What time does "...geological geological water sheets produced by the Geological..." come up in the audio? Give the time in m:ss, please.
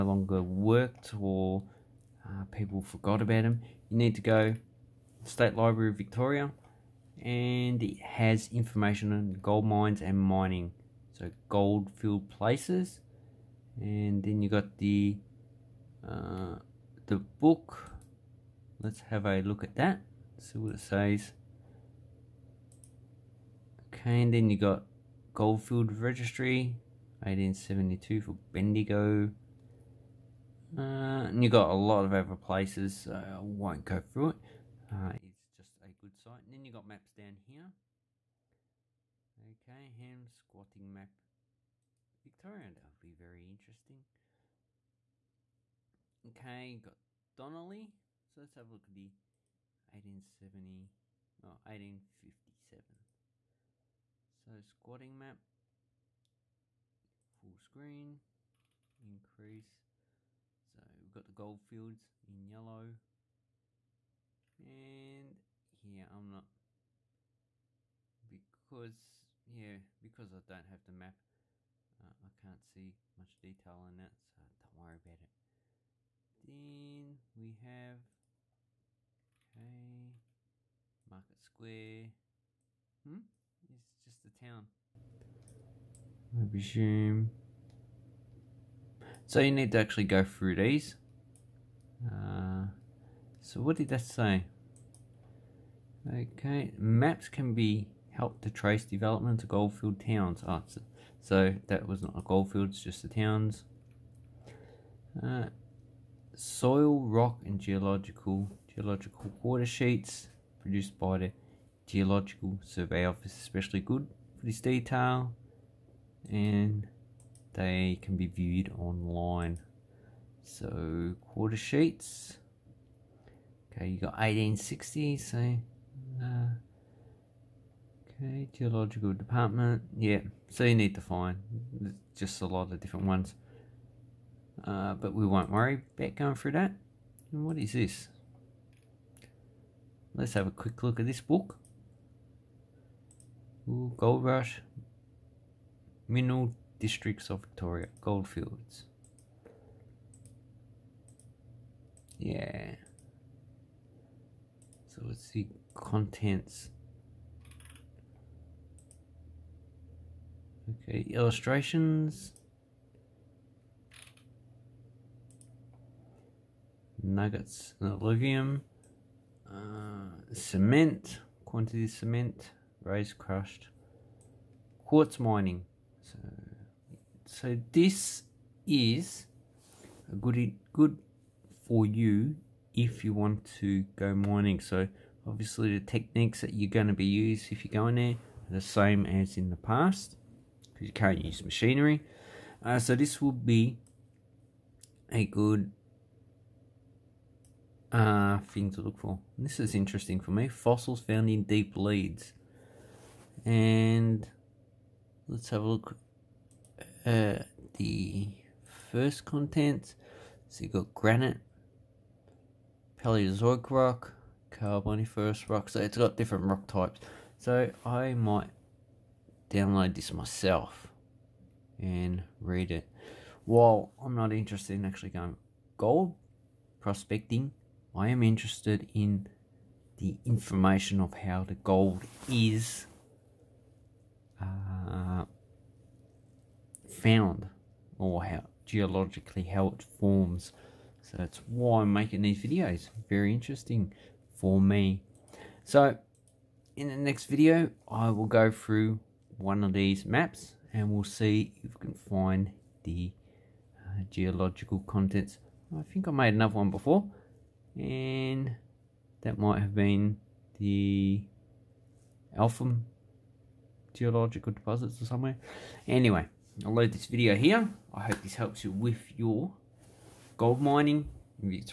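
1:47.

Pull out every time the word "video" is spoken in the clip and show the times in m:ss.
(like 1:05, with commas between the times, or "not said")
4:02, 4:07, 4:27.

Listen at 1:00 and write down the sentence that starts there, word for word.
So we've got the gold fields in yellow.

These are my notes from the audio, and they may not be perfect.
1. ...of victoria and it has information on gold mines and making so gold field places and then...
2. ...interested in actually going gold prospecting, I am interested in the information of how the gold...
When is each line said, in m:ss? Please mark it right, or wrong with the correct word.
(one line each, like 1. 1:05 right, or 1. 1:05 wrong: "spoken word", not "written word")
1. 0:05 wrong: "mining", not "making"
2. 3:44 right.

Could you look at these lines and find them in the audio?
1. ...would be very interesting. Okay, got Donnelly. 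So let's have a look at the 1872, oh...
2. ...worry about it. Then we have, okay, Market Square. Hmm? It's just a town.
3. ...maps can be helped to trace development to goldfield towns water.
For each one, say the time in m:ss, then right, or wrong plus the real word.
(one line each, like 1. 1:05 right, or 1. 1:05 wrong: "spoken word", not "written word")
1. 0:42 wrong: "1870", not "1872"
2. 1:14 right
3. 1:36 wrong: "answer", not "water".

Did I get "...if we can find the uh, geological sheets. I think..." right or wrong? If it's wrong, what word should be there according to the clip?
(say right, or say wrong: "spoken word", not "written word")
wrong: "contents", not "sheets".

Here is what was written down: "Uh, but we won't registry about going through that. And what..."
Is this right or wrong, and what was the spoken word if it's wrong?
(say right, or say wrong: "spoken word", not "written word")
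wrong: "worry", not "registry".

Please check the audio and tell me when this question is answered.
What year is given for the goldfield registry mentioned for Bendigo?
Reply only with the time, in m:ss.
0:27.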